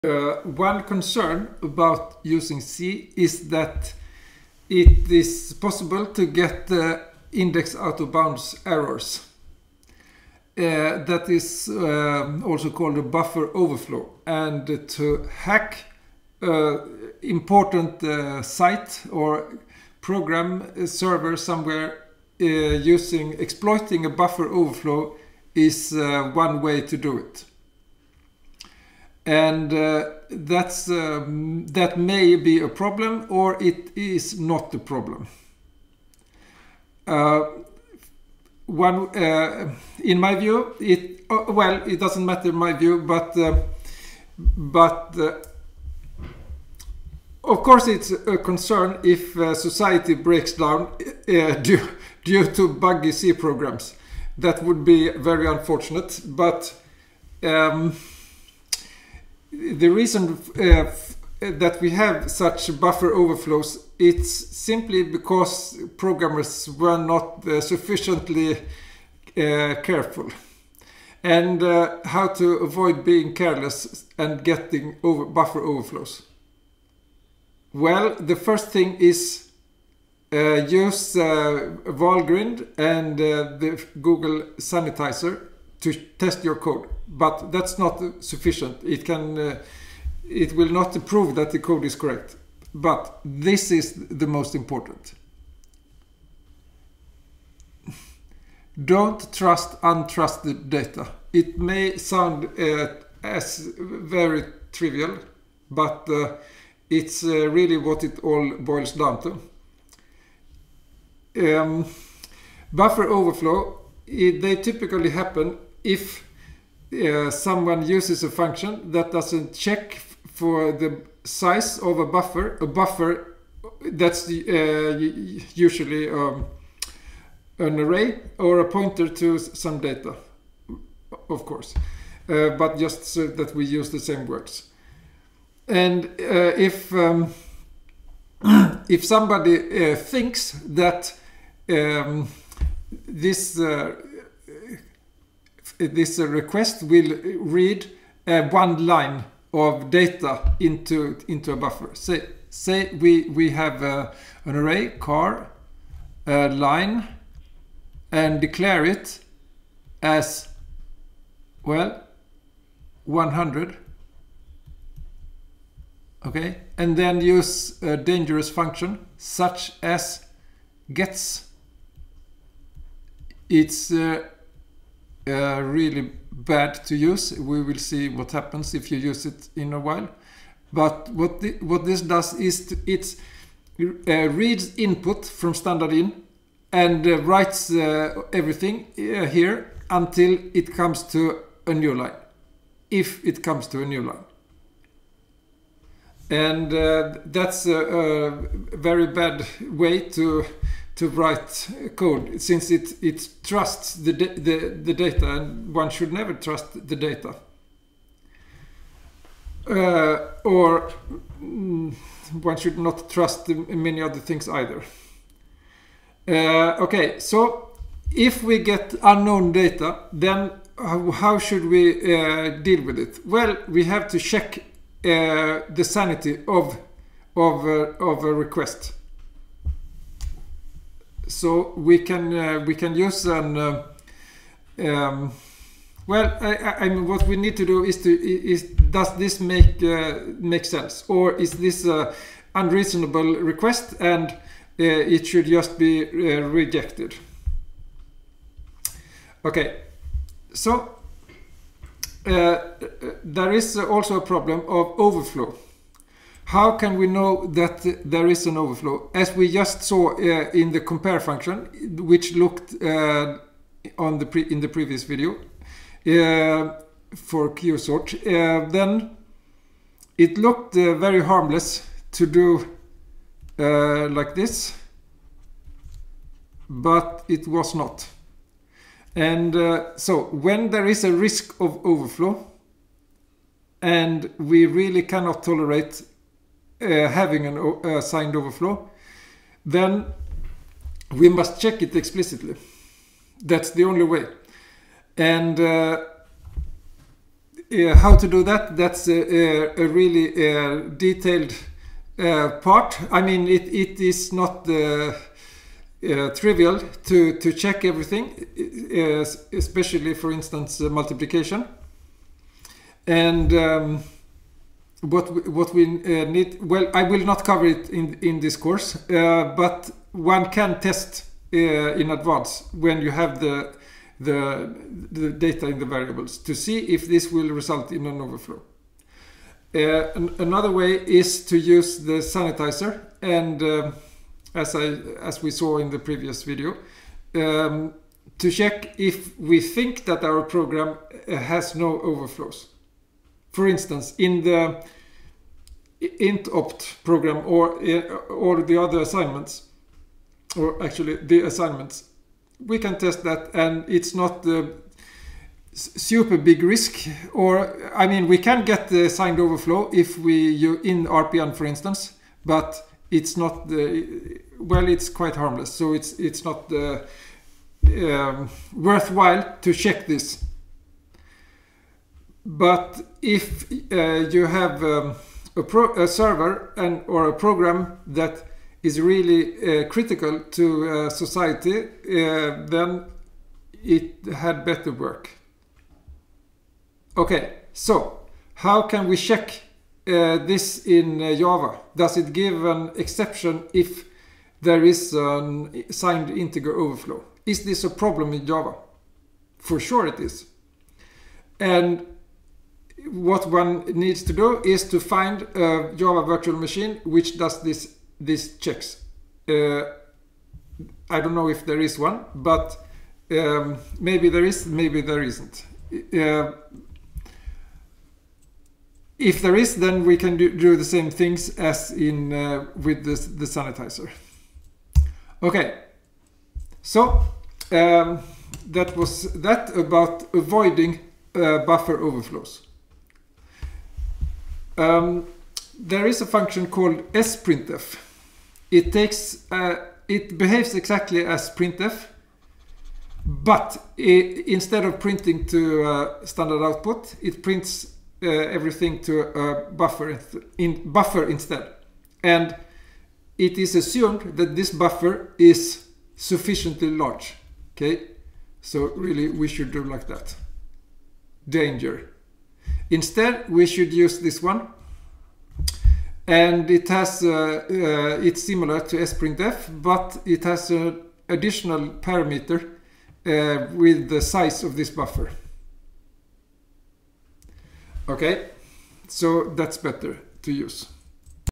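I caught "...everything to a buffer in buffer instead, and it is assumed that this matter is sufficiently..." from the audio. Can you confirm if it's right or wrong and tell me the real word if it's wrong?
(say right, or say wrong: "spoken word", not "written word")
wrong: "buffer", not "matter".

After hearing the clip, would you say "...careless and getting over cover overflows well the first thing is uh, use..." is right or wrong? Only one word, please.
wrong.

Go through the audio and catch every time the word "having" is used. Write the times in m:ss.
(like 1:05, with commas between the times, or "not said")
4:47.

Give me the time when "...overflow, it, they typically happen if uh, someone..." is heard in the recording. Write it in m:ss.
1:53.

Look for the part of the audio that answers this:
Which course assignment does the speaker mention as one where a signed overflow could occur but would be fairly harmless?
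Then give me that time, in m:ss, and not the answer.
6:01.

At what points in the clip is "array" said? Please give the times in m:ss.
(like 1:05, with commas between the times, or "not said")
2:07, 2:34.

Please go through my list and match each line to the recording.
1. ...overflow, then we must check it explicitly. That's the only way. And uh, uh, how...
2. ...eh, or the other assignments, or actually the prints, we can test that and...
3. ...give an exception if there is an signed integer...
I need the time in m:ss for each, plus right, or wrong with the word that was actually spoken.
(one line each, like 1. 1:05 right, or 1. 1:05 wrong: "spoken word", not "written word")
1. 4:48 right
2. 5:47 wrong: "assignments", not "prints"
3. 6:32 right.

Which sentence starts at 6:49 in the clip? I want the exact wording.
Uh, I don't know if there is one, but um, maybe there is, maybe there isn't.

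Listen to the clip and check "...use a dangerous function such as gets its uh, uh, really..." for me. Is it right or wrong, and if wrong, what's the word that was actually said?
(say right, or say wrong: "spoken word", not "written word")
right.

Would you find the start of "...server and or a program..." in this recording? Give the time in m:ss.
6:16.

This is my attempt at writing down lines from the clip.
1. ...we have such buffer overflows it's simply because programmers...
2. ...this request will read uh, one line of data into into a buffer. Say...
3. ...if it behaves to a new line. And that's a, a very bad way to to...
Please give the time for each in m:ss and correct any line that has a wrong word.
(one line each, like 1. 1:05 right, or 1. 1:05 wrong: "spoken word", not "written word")
1. 1:01 right
2. 2:25 right
3. 3:12 wrong: "comes", not "behaves".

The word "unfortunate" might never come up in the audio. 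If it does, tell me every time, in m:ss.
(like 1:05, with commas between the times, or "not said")
0:55.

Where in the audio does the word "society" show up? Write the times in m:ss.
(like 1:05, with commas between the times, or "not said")
0:49, 6:21.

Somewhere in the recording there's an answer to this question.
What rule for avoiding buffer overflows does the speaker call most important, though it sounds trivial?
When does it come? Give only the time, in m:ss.
1:38.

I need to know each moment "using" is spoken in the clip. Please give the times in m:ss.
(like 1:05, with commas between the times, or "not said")
0:02, 0:22.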